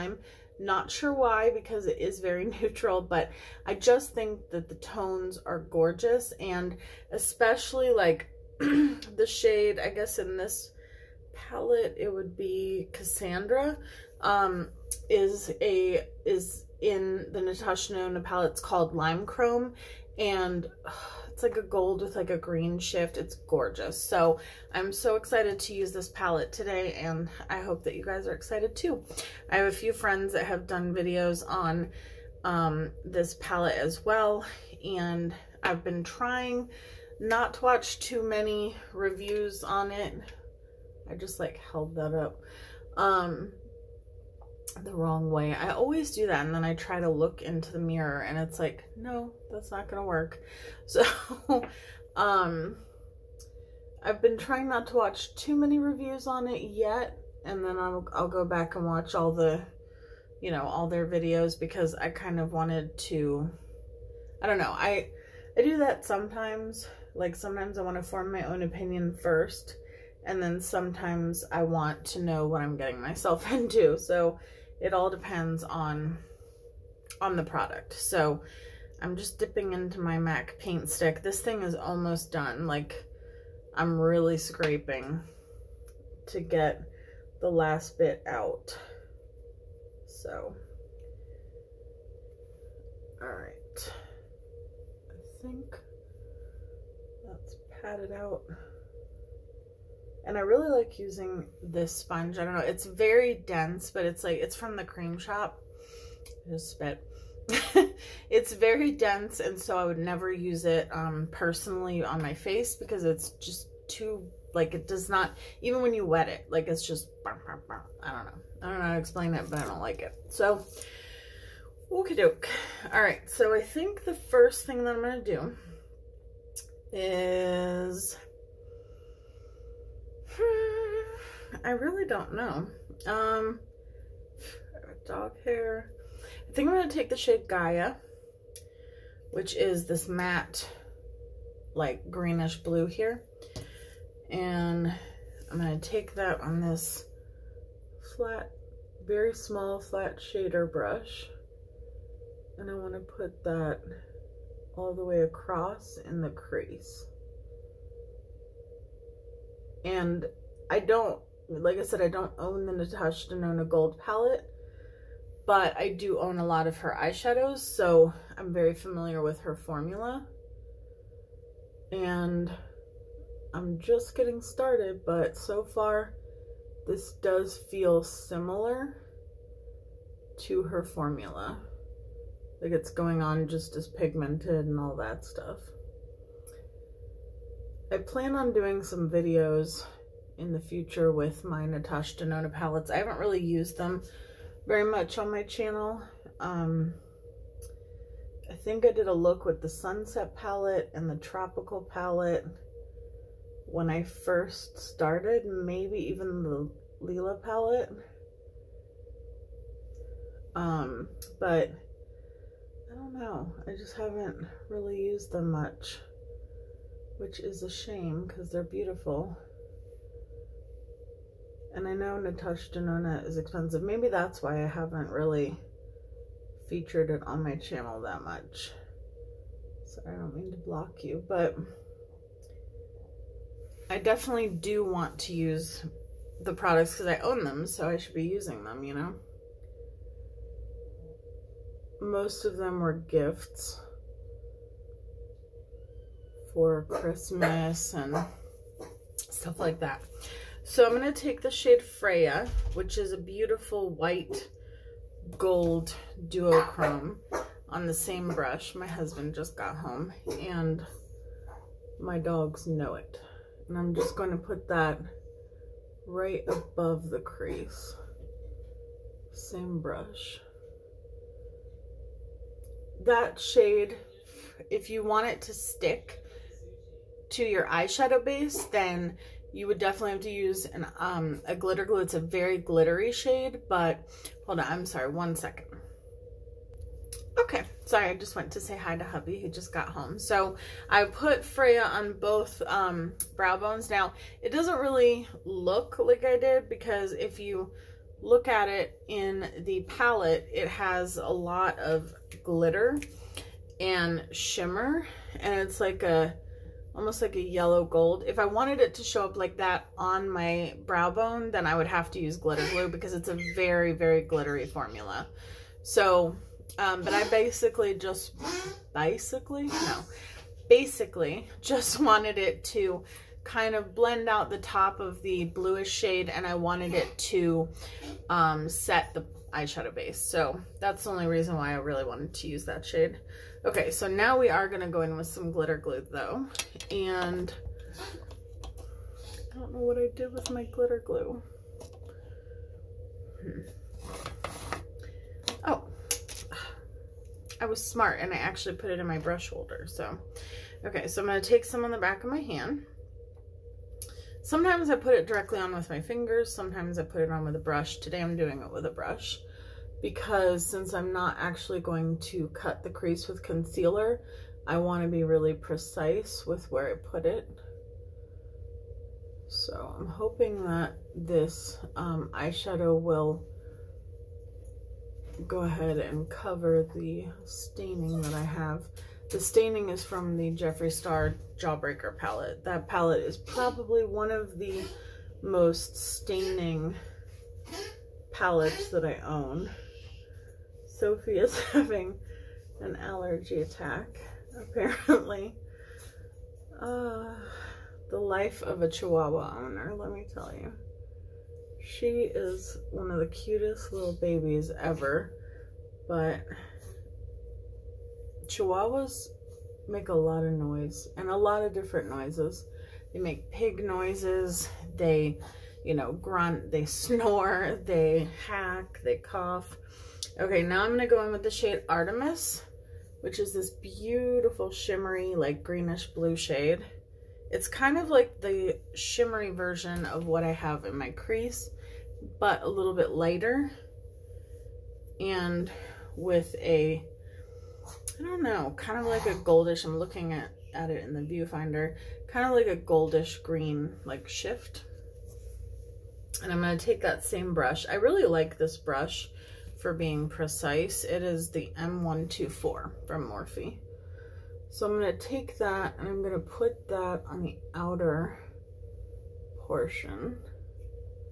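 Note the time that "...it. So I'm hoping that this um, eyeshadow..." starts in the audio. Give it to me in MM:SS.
06:07.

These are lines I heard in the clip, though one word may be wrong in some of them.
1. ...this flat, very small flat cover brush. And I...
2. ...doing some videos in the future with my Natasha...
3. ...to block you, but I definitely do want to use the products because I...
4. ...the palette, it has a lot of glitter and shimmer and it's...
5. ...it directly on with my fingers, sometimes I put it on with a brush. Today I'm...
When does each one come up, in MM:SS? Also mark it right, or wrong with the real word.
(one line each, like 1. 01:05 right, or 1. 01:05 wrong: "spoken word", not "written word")
1. 02:26 wrong: "shader", not "cover"
2. 03:08 right
3. 03:50 right
4. 04:59 right
5. 05:55 right.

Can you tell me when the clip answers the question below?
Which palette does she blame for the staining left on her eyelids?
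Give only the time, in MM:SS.
06:20.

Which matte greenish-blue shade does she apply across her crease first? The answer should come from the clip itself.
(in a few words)
Gaia.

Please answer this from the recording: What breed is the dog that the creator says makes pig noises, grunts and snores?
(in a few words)
Chihuahua.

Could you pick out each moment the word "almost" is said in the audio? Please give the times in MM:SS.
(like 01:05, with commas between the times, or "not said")
01:21, 05:06.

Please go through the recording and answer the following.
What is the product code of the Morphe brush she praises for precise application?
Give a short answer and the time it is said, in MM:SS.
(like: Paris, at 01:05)
M124, at 07:31.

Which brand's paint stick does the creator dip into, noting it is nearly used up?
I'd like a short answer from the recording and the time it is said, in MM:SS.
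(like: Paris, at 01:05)
MAC, at 01:20.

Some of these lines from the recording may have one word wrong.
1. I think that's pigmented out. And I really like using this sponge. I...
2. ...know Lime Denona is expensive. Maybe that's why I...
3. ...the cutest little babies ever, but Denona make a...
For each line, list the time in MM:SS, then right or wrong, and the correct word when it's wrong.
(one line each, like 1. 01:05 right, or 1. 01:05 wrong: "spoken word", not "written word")
1. 01:33 wrong: "padded", not "pigmented"
2. 03:41 wrong: "Natasha", not "Lime"
3. 06:43 wrong: "Chihuahuas", not "Denona".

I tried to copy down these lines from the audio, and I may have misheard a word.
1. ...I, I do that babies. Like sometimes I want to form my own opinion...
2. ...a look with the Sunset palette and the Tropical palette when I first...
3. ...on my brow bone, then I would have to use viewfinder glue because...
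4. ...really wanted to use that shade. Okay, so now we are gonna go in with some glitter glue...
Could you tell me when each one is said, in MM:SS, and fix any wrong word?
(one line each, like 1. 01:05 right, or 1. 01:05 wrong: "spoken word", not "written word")
1. 01:04 wrong: "sometimes", not "babies"
2. 03:19 right
3. 05:09 wrong: "glitter", not "viewfinder"
4. 05:31 right.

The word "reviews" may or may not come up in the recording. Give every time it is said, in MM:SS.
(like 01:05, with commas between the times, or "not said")
00:38, 00:55.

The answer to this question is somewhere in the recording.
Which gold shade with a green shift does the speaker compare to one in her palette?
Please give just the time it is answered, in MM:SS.
00:18.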